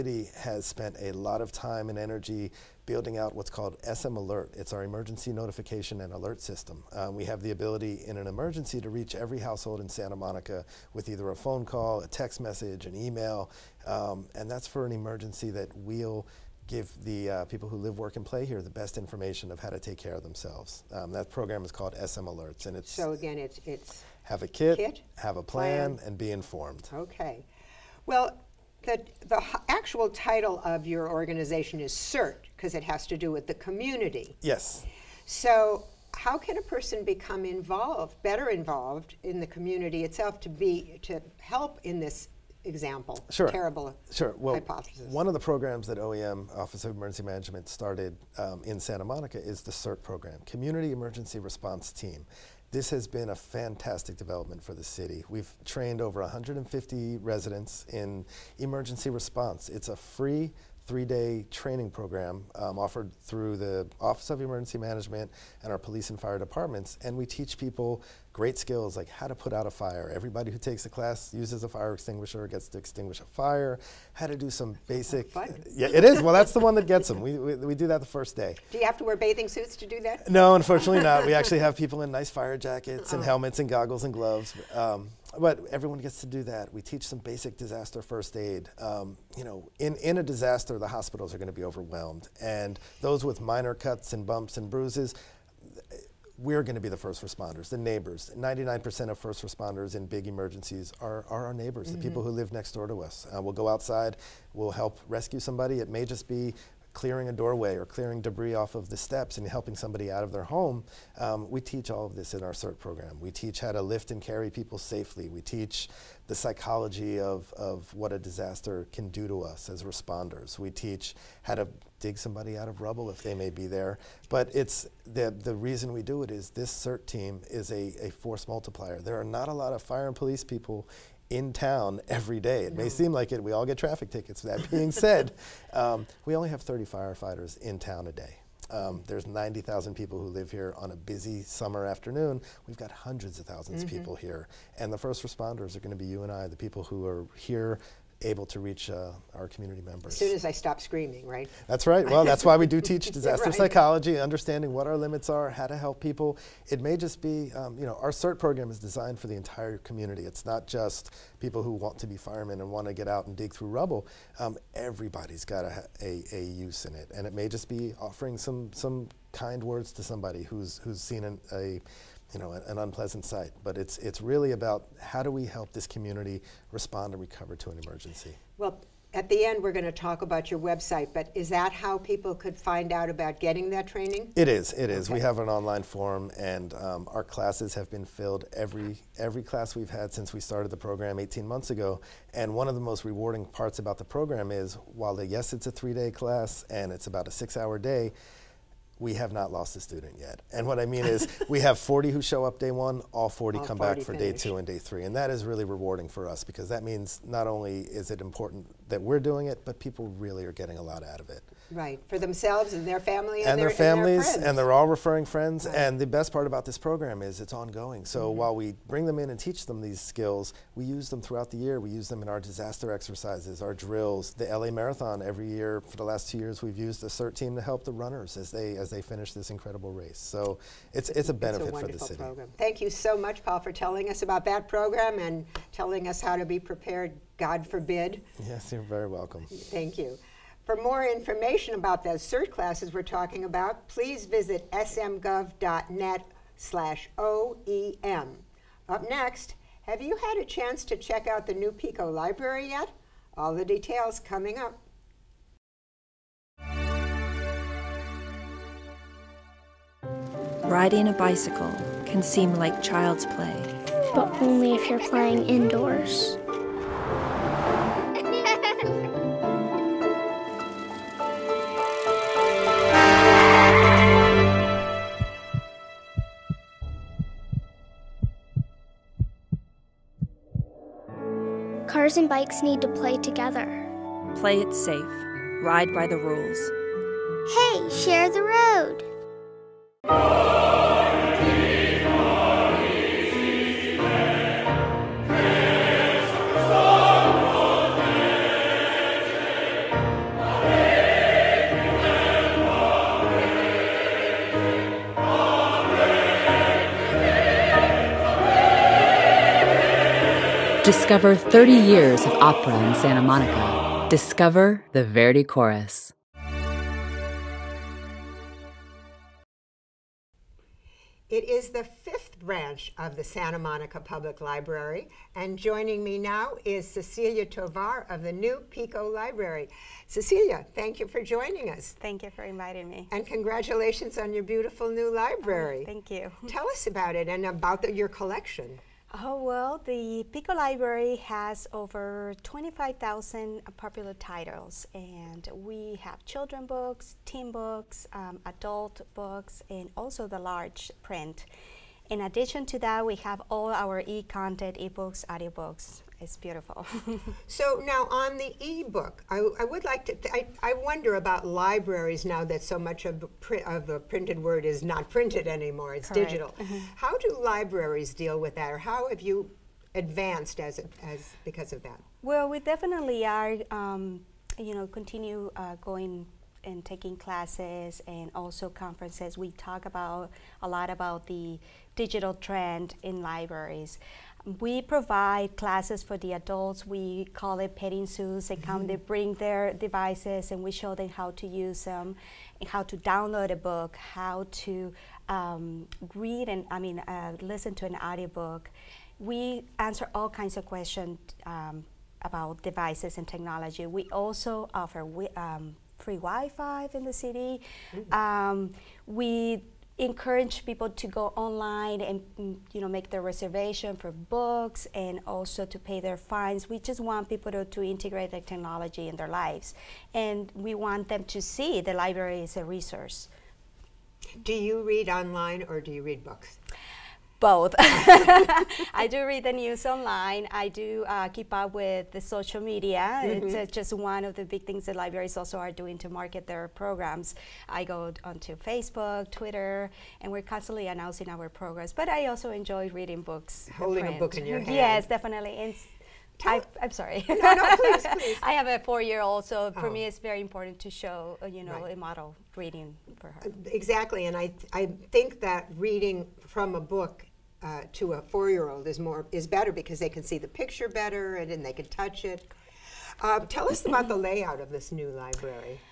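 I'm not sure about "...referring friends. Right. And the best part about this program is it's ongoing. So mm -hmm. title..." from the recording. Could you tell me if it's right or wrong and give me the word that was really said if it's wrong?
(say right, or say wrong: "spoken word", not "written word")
wrong: "while", not "title".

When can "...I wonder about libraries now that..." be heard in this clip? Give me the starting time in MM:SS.
06:00.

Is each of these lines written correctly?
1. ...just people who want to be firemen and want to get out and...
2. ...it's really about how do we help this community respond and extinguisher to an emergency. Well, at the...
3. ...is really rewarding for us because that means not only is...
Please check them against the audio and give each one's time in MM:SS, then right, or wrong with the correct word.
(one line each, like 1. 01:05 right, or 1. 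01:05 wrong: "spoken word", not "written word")
1. 02:40 right
2. 02:53 wrong: "recover", not "extinguisher"
3. 03:25 right.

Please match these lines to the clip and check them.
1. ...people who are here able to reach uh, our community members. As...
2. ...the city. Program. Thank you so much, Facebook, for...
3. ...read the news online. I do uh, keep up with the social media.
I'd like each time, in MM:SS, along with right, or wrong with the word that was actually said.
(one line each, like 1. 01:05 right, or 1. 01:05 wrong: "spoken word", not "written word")
1. 02:26 right
2. 03:51 wrong: "Paul", not "Facebook"
3. 07:09 right.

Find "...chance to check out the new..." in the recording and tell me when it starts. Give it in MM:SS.
04:10.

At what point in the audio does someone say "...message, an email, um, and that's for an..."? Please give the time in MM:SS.
00:12.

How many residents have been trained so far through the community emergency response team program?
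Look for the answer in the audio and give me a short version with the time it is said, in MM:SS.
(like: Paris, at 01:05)
over 150, at 00:56.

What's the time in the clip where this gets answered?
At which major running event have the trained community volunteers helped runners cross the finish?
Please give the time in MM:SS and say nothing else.
03:44.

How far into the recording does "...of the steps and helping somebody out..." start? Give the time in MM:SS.
01:48.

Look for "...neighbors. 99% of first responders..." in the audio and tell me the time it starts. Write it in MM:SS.
01:37.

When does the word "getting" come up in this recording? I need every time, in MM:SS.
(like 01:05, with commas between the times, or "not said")
03:03, 03:30.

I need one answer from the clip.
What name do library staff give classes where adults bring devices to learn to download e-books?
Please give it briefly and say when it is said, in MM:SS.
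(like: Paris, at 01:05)
petting zoos, at 06:27.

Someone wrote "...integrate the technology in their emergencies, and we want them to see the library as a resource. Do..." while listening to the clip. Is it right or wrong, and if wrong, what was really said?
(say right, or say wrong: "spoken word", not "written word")
wrong: "lives", not "emergencies".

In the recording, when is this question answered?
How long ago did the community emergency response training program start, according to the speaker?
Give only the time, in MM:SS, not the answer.
03:11.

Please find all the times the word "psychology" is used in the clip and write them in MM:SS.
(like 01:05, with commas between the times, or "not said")
01:56, 02:33.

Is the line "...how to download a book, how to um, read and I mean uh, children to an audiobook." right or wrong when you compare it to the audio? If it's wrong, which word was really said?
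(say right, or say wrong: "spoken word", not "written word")
wrong: "listen", not "children".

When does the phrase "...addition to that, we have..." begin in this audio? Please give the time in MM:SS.
05:52.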